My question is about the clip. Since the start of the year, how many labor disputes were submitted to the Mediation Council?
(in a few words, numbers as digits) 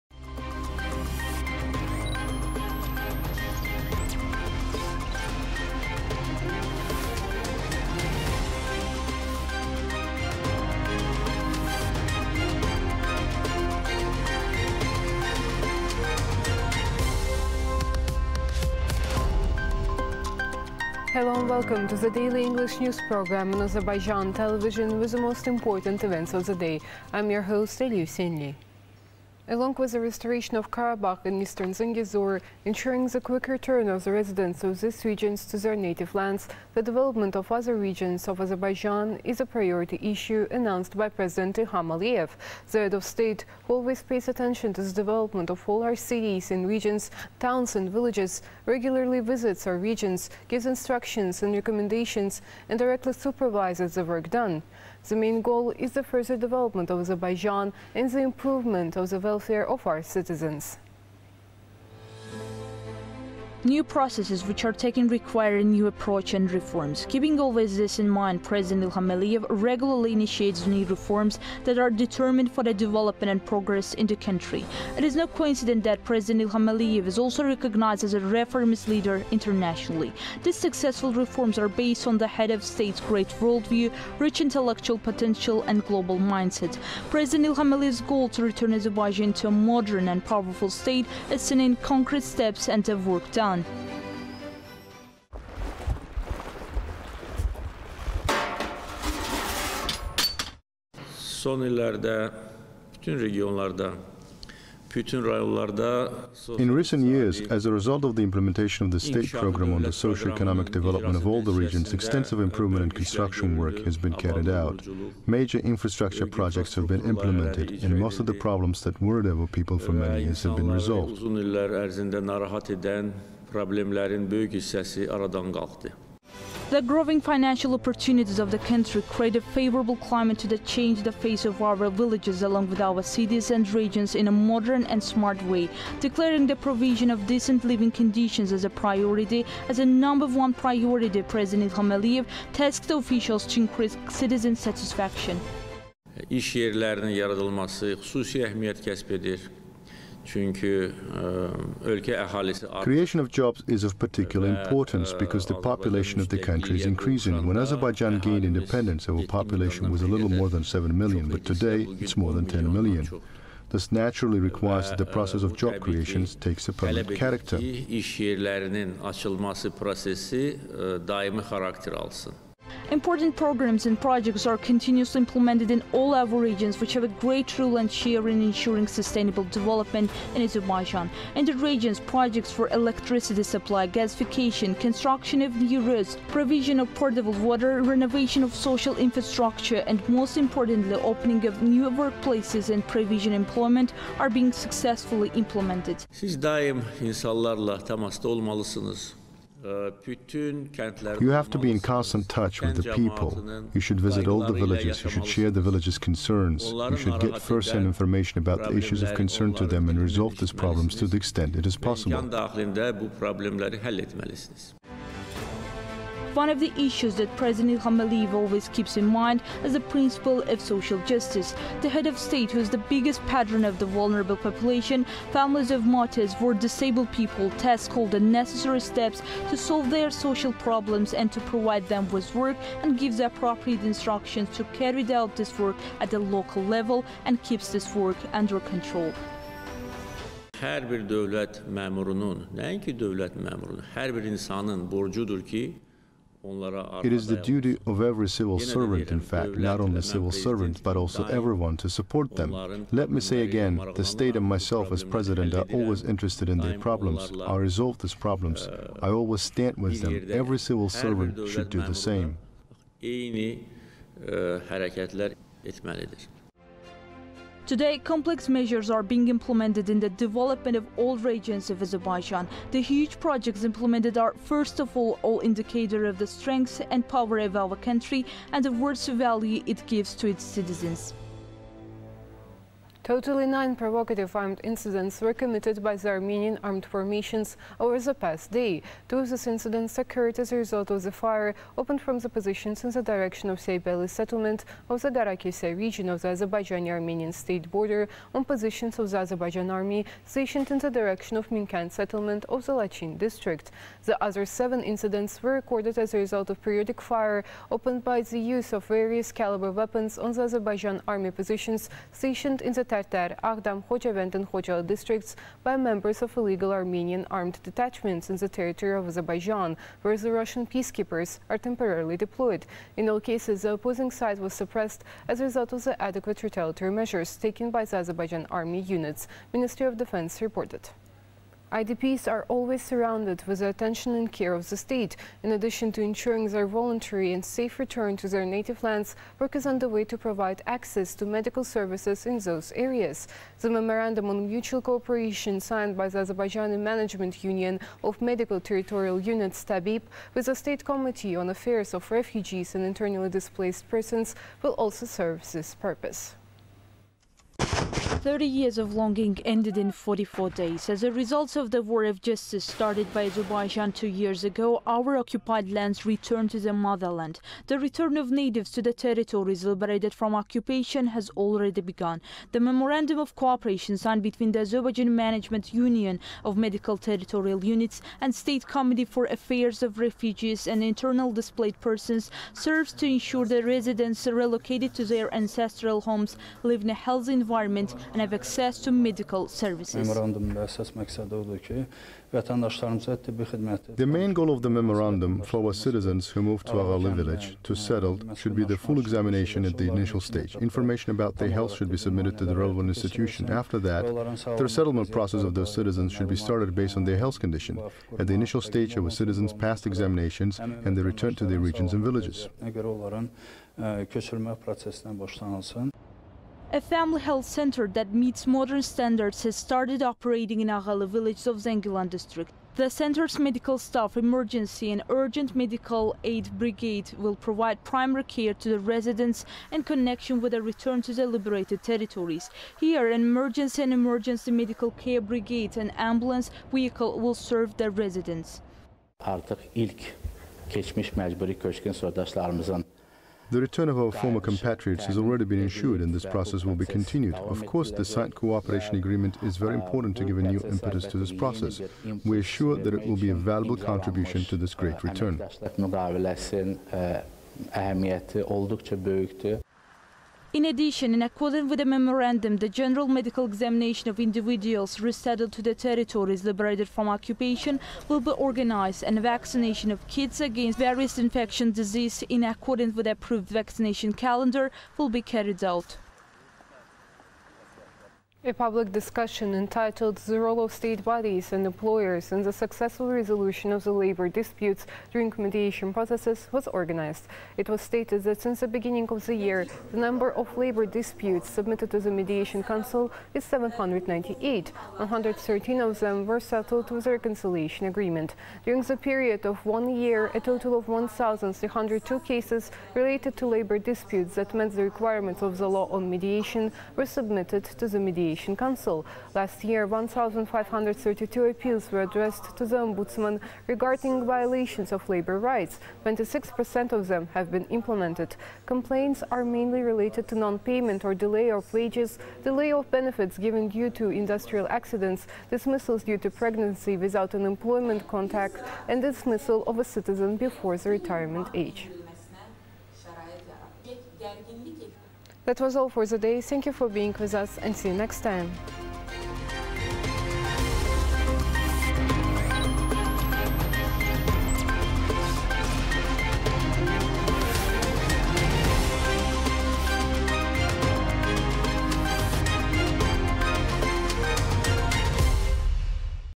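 798.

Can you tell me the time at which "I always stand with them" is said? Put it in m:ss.
4:19.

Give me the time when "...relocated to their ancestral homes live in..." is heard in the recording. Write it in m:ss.
6:24.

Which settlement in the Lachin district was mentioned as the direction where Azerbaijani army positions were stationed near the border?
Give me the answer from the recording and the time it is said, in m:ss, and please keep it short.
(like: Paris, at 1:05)
Minkend, at 5:01.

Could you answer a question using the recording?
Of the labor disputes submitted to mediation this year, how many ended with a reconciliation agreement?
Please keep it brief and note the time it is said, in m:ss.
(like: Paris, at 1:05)
113, at 8:14.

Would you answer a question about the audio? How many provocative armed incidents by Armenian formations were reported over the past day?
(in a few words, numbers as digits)
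nine.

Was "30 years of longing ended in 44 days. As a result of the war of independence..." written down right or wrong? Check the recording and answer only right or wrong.
wrong.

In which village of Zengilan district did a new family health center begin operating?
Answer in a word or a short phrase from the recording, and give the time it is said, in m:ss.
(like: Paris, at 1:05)
Aghalı, at 7:00.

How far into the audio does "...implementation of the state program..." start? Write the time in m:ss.
1:48.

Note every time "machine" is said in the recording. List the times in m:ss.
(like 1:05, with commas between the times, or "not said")
not said.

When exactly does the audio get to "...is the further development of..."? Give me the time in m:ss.
0:55.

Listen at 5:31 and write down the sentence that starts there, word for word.
IDPs are always surrounded with the attention and care of the state.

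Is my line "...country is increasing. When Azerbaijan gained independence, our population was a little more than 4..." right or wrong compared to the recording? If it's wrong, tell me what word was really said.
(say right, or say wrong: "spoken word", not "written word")
wrong: "7", not "4".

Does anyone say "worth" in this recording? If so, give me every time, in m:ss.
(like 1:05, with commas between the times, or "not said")
4:38.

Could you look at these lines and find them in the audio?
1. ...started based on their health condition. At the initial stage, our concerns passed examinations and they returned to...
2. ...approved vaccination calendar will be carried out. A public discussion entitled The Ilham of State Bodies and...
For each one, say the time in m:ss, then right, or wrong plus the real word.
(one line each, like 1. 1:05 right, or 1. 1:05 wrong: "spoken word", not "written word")
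1. 6:46 wrong: "citizens", not "concerns"
2. 7:53 wrong: "Role", not "Ilham".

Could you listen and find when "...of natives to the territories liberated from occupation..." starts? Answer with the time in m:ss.
6:08.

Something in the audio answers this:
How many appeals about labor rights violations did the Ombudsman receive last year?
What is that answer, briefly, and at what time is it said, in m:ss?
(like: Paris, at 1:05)
1,532, at 8:29.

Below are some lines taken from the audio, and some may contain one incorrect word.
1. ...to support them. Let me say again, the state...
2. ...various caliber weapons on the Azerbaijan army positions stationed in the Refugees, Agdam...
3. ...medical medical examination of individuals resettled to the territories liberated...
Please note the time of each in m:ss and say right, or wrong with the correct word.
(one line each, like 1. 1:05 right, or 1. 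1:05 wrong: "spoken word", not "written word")
1. 4:11 right
2. 5:08 wrong: "Tartar", not "Refugees"
3. 7:42 wrong: "general", not "medical".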